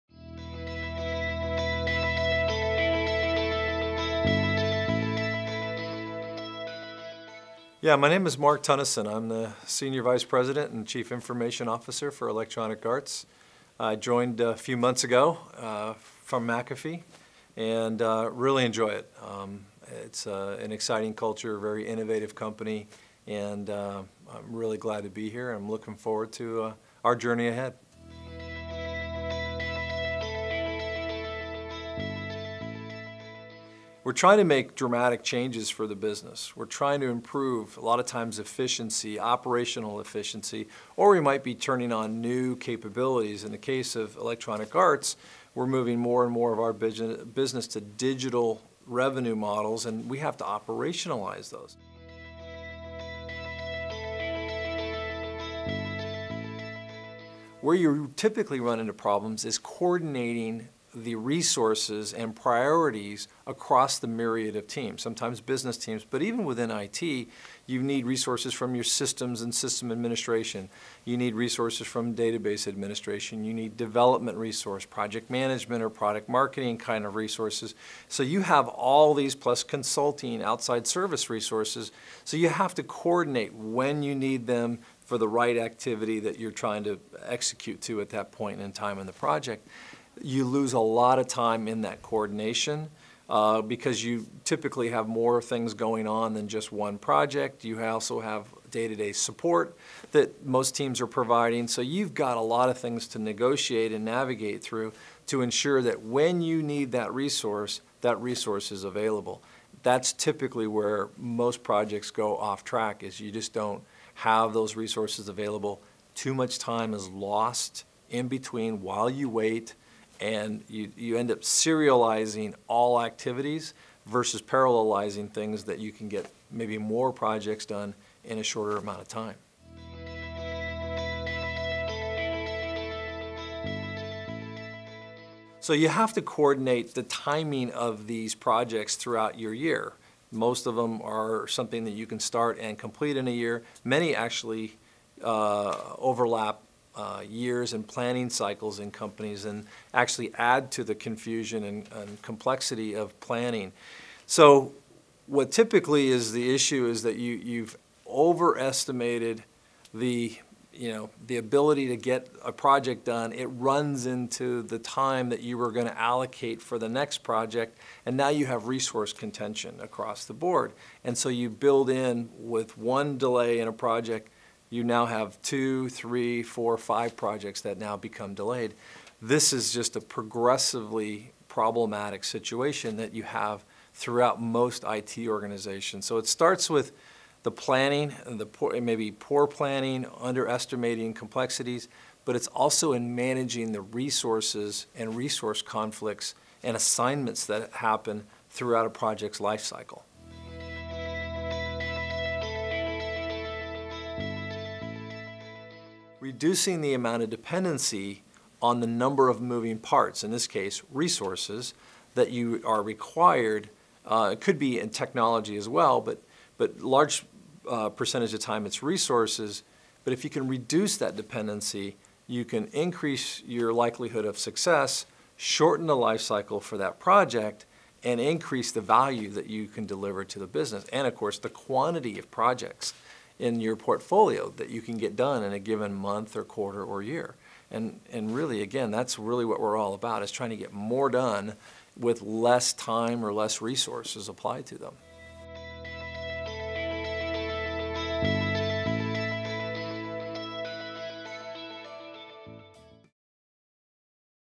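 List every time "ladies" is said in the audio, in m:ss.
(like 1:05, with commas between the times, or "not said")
not said.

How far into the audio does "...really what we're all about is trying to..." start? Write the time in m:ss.
3:59.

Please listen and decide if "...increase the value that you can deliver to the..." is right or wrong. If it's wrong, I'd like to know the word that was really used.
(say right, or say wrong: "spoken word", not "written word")
right.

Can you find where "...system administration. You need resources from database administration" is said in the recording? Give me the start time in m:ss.
1:09.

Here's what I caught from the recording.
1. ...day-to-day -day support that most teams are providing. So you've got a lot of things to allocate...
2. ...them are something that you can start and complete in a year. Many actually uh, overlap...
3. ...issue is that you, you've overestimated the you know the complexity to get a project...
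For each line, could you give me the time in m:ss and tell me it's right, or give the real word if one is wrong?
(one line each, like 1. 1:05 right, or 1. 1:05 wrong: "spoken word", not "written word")
1. 1:38 wrong: "negotiate", not "allocate"
2. 2:20 right
3. 2:36 wrong: "ability", not "complexity".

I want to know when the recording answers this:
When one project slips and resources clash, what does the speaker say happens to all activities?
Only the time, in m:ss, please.
2:01.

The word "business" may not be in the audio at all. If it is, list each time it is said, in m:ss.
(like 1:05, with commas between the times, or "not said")
0:35, 0:46, 1:05, 3:50.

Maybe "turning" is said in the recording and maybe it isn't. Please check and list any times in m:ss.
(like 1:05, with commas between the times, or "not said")
0:41.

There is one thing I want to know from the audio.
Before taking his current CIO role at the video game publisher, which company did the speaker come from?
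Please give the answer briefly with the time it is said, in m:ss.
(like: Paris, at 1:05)
McAfee, at 0:16.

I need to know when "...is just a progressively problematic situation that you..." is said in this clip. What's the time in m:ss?
2:59.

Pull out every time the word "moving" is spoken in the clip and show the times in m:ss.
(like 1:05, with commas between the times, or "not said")
0:45, 3:29.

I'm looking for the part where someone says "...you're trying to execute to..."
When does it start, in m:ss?
1:26.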